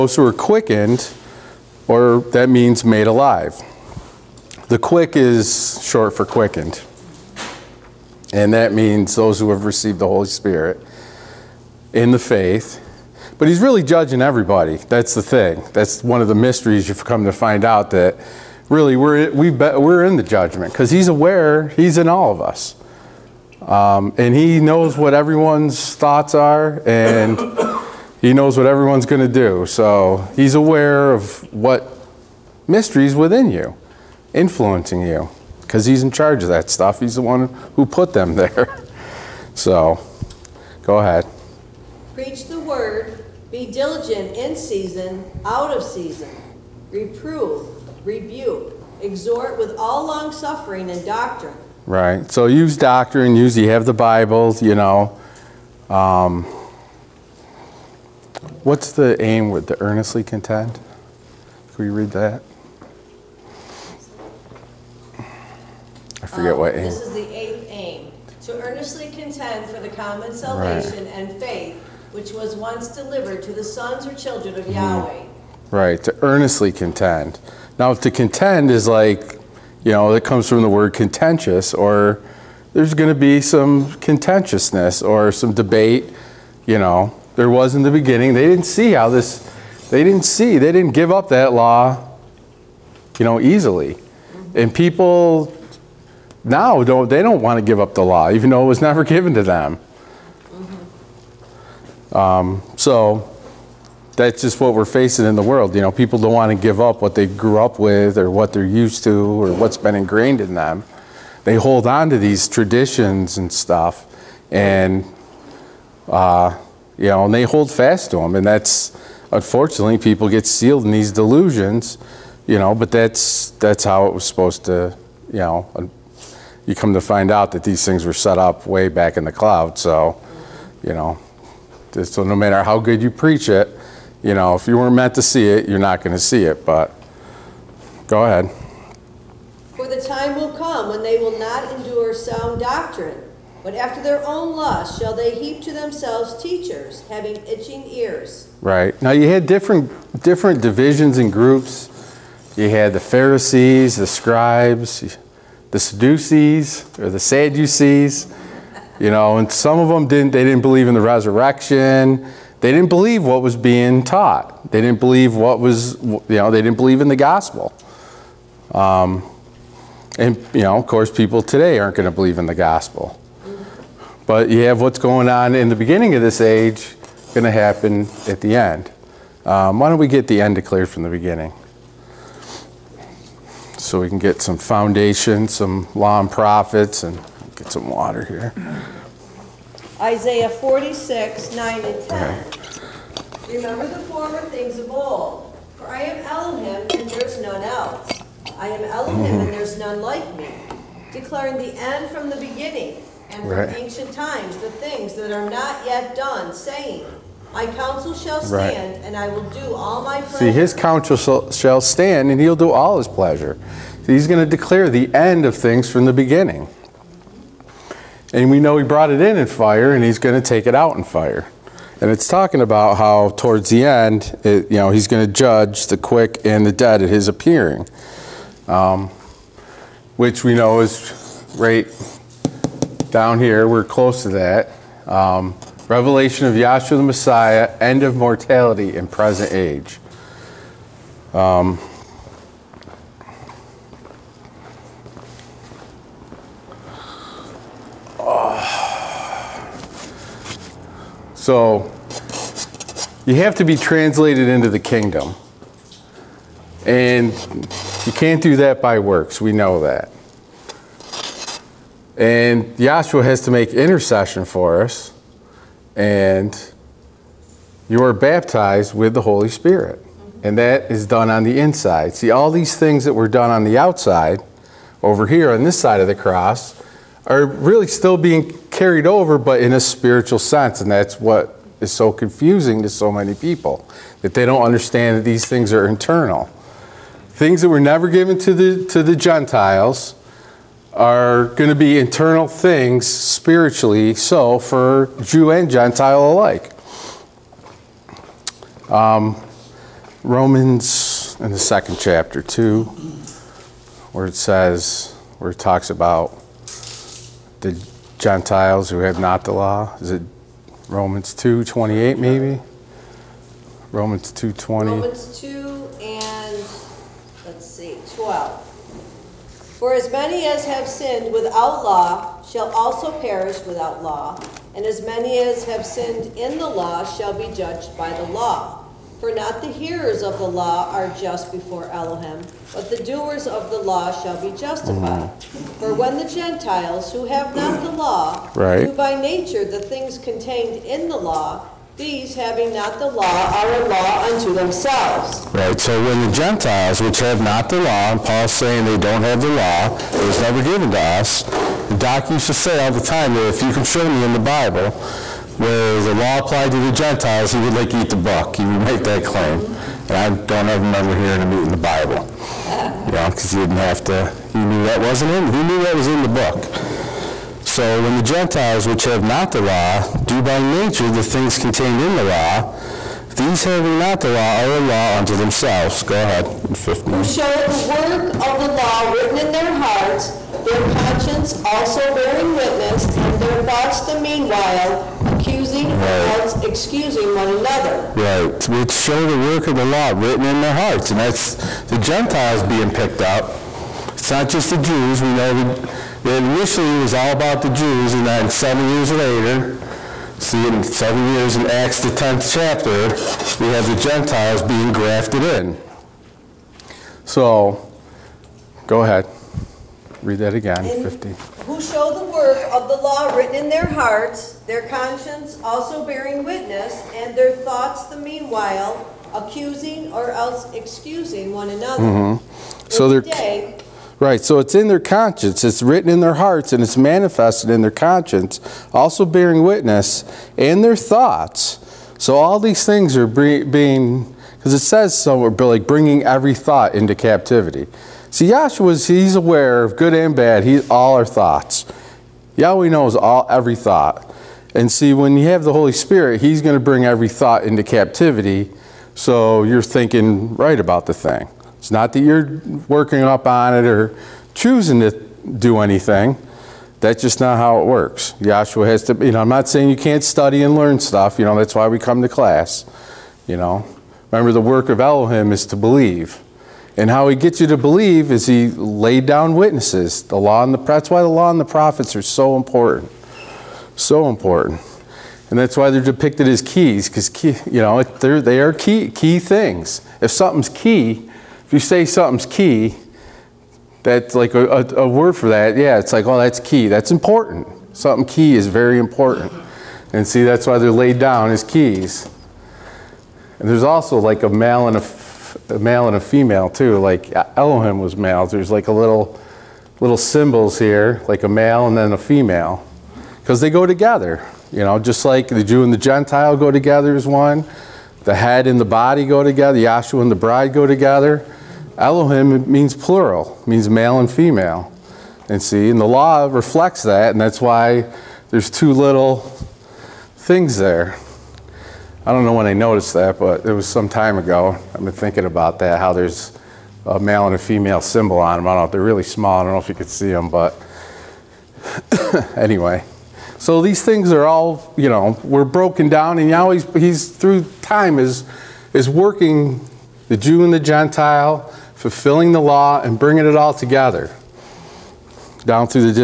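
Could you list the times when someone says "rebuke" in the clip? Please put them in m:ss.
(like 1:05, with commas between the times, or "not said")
0:48.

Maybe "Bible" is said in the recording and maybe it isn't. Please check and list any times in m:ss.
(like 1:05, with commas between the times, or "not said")
0:53, 5:54, 6:01.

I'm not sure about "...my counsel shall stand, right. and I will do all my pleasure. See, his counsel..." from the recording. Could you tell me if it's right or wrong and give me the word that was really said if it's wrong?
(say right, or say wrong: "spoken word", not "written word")
right.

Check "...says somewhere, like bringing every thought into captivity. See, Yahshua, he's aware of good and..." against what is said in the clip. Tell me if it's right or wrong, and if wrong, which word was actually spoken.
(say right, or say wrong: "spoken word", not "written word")
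right.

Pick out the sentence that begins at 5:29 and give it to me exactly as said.
For not the hearers of the law are just before Elohim, but the doers of the law shall be justified.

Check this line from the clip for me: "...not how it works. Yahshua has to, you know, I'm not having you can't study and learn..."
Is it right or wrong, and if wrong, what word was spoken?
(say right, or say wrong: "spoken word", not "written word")
wrong: "saying", not "having".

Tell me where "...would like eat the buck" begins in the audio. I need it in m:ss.
5:57.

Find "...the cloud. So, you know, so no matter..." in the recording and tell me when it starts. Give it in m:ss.
2:09.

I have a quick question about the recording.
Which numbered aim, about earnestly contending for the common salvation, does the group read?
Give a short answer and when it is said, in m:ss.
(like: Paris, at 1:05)
eighth, at 1:07.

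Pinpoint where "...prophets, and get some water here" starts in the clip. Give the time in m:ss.
3:06.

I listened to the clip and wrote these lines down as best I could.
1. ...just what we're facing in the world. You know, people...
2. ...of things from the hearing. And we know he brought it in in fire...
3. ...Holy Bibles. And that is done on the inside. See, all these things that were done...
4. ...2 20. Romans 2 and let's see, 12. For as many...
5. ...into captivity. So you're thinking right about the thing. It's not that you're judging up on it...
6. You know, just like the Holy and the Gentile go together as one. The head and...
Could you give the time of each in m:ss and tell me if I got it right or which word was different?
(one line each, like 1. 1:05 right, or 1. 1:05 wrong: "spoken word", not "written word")
1. 1:44 right
2. 3:35 wrong: "beginning", not "hearing"
3. 4:29 wrong: "Spirit", not "Bibles"
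4. 5:14 right
5. 7:27 wrong: "working", not "judging"
6. 8:24 wrong: "Jew", not "Holy".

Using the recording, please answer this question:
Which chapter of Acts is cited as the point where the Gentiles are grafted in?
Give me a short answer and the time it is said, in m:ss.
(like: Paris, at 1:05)
10th, at 6:42.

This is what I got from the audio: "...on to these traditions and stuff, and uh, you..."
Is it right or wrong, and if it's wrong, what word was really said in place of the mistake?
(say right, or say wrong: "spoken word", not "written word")
right.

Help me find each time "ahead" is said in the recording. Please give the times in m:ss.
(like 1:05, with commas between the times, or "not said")
0:40, 2:18, 6:16, 6:49.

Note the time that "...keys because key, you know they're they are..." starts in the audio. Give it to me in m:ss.
7:56.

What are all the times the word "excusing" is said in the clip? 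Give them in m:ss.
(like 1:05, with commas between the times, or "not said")
6:26, 7:00.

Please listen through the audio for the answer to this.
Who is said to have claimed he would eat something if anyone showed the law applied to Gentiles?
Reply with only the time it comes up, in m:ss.
5:51.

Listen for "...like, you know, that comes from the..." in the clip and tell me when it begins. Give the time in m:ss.
1:18.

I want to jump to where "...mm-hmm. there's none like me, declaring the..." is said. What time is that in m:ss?
3:19.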